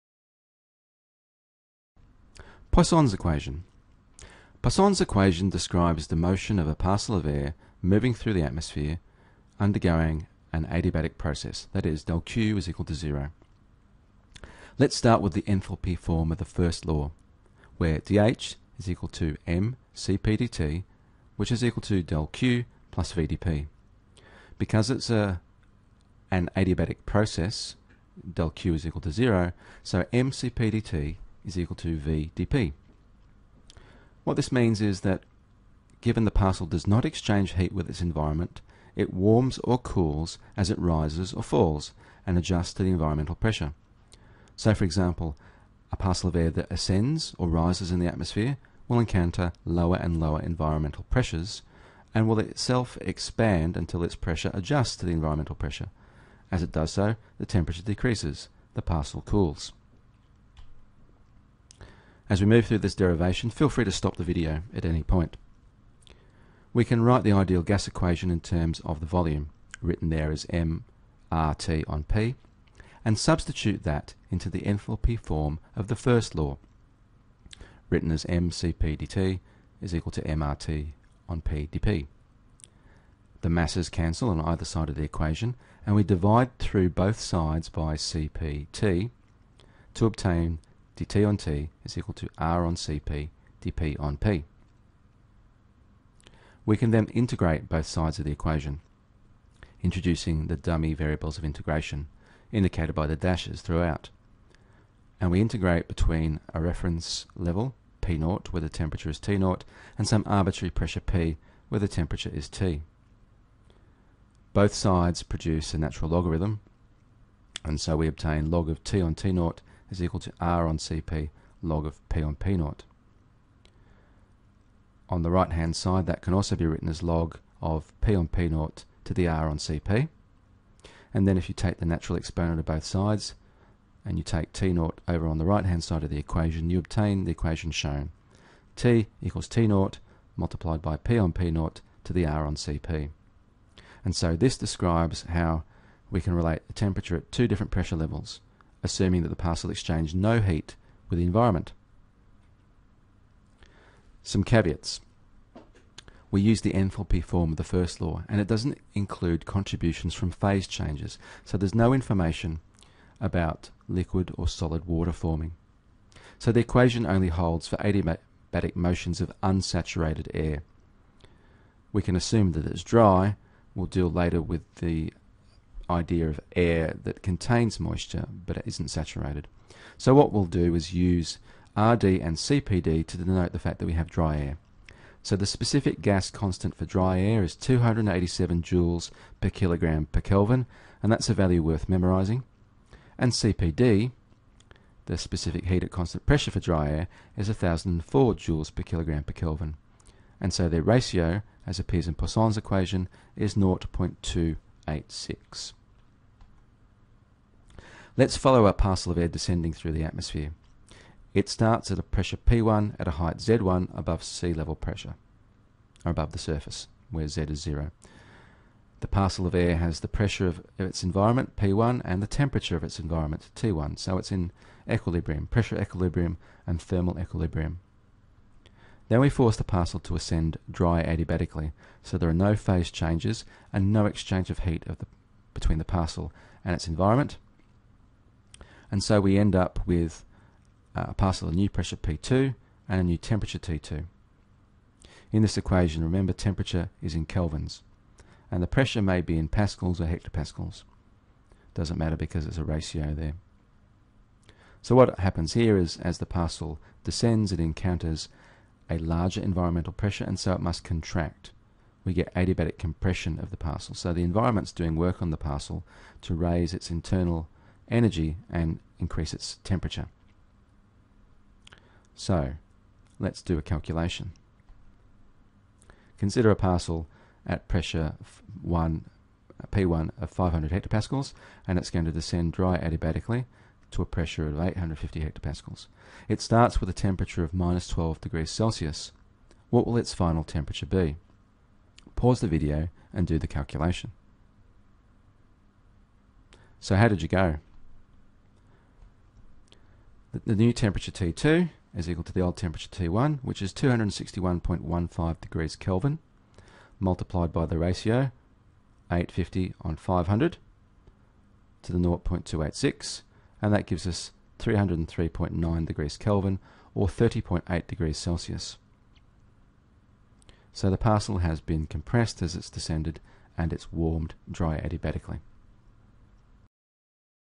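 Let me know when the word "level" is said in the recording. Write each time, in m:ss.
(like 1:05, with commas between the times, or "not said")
1:47, 2:27, 3:34.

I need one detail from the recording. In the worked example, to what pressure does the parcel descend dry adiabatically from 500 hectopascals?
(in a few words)
850 hectopascals.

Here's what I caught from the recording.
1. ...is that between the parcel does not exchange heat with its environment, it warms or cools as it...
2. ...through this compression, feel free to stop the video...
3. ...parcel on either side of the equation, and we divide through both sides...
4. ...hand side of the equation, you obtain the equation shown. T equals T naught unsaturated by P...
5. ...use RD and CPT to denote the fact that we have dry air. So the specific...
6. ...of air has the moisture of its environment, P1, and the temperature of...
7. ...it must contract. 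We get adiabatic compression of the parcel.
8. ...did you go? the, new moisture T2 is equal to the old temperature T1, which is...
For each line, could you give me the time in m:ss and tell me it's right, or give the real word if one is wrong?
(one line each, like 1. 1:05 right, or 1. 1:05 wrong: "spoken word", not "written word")
1. 0:34 wrong: "given", not "between"
2. 1:02 wrong: "derivation", not "compression"
3. 1:23 wrong: "cancel", not "parcel"
4. 2:15 wrong: "multiplied", not "unsaturated"
5. 3:00 wrong: "CPD", not "CPT"
6. 3:39 wrong: "pressure", not "moisture"
7. 4:20 right
8. 4:57 wrong: "temperature", not "moisture".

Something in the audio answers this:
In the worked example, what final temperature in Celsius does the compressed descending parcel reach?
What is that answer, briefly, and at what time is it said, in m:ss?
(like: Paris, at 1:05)
30.8 degrees Celsius, at 5:17.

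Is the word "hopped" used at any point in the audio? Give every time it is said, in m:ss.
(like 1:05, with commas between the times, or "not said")
not said.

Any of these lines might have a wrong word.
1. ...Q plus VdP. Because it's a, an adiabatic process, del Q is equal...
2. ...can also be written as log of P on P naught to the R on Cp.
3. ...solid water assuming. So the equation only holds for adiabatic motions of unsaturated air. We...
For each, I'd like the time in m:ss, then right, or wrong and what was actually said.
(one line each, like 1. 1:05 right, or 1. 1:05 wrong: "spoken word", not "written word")
1. 0:22 right
2. 2:06 right
3. 2:44 wrong: "forming", not "assuming".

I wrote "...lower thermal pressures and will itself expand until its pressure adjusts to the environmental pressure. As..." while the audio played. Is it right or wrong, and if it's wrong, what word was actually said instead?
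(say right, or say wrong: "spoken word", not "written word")
wrong: "environmental", not "thermal".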